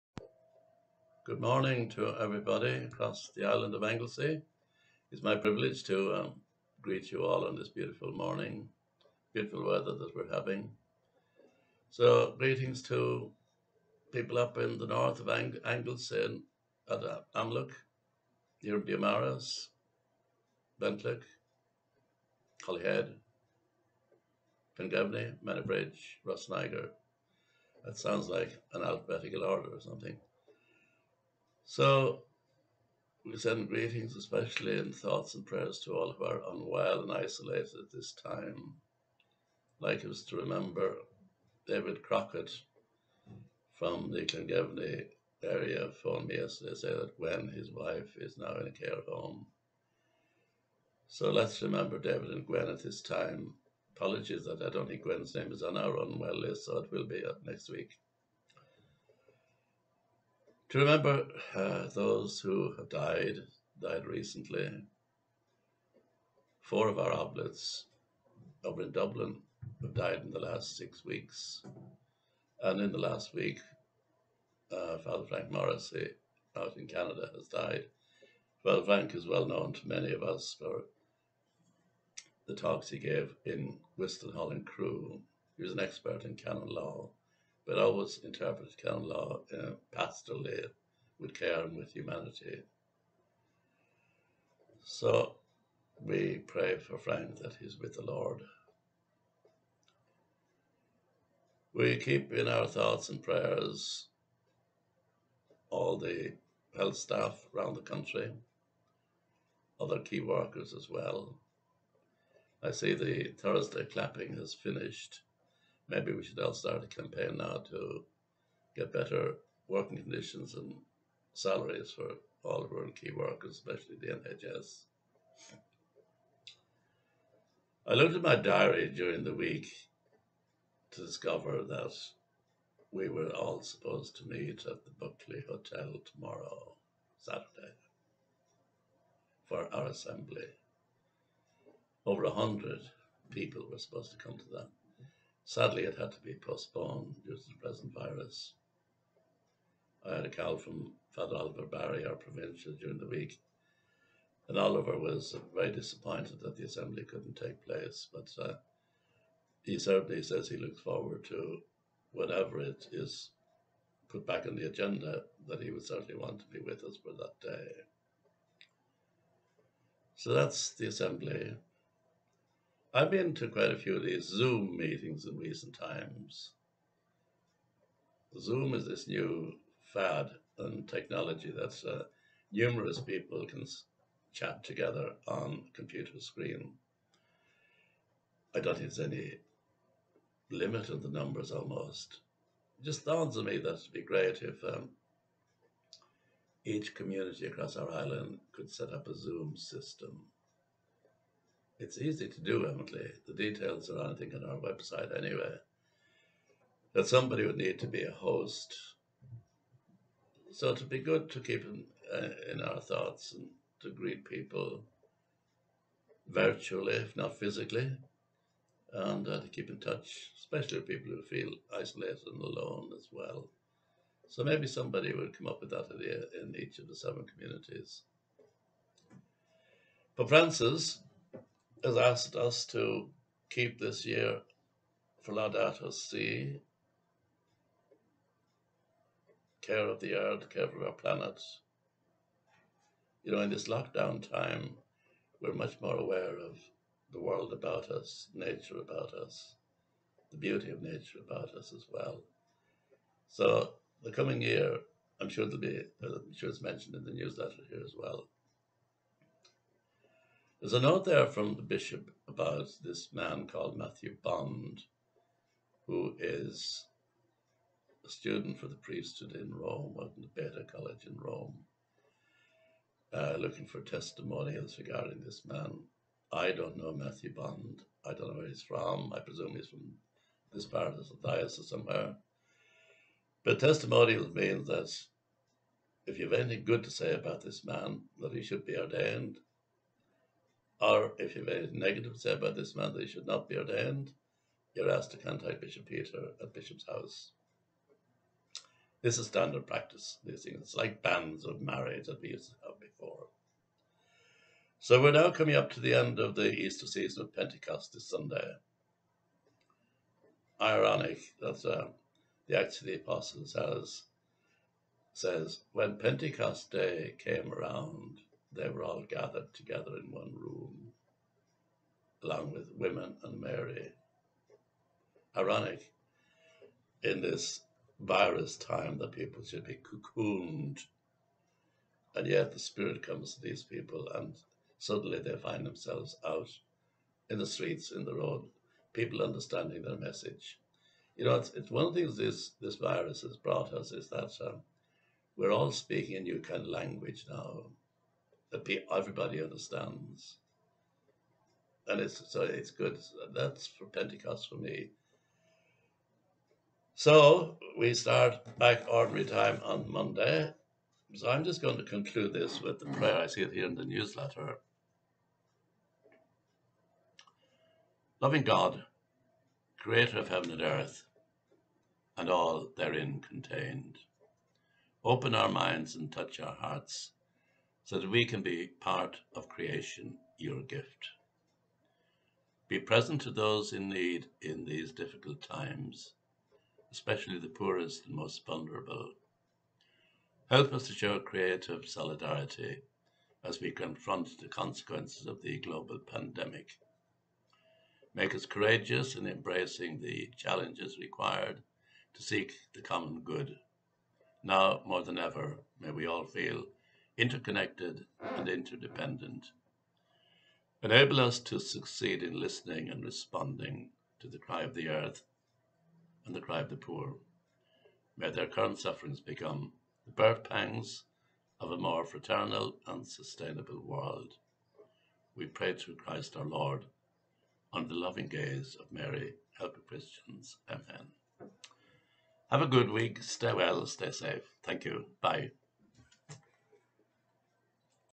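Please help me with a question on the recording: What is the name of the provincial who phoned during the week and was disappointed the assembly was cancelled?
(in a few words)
Oliver Barry.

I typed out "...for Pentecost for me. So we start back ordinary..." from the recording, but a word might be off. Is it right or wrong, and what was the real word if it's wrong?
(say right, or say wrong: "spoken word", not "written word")
right.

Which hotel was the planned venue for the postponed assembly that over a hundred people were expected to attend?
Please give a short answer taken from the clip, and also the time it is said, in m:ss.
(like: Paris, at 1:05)
Buckley Hotel, at 2:14.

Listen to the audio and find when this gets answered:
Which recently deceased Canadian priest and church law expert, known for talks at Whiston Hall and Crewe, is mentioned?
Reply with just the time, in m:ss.
1:14.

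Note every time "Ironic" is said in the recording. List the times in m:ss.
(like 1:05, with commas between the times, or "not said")
5:10, 5:25.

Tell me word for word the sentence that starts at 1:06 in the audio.
Four of our oblates over in Dublin have died in the last six weeks.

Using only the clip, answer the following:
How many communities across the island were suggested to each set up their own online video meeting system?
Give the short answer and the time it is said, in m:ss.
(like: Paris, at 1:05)
7, at 3:46.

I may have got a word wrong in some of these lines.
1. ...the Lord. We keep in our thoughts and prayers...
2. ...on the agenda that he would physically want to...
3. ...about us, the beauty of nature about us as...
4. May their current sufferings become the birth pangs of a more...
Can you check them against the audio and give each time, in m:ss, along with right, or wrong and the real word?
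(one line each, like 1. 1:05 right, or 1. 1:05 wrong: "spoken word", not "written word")
1. 1:37 right
2. 2:44 wrong: "certainly", not "physically"
3. 4:08 right
4. 6:58 right.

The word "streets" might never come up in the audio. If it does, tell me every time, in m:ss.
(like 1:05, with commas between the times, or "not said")
5:37.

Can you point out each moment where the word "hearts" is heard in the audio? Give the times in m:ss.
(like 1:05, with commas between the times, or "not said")
6:16.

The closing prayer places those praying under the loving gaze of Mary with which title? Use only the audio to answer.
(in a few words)
Help of Christians.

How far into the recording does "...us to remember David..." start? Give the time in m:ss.
0:40.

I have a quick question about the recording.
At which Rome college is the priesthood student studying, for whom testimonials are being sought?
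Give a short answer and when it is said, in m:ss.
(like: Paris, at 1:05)
Beda College, at 4:30.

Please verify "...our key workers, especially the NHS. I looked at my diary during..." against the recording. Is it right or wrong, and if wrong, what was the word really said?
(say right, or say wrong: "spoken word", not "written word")
right.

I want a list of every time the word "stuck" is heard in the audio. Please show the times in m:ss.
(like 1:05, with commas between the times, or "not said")
not said.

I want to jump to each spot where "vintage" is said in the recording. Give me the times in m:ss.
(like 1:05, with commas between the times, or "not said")
not said.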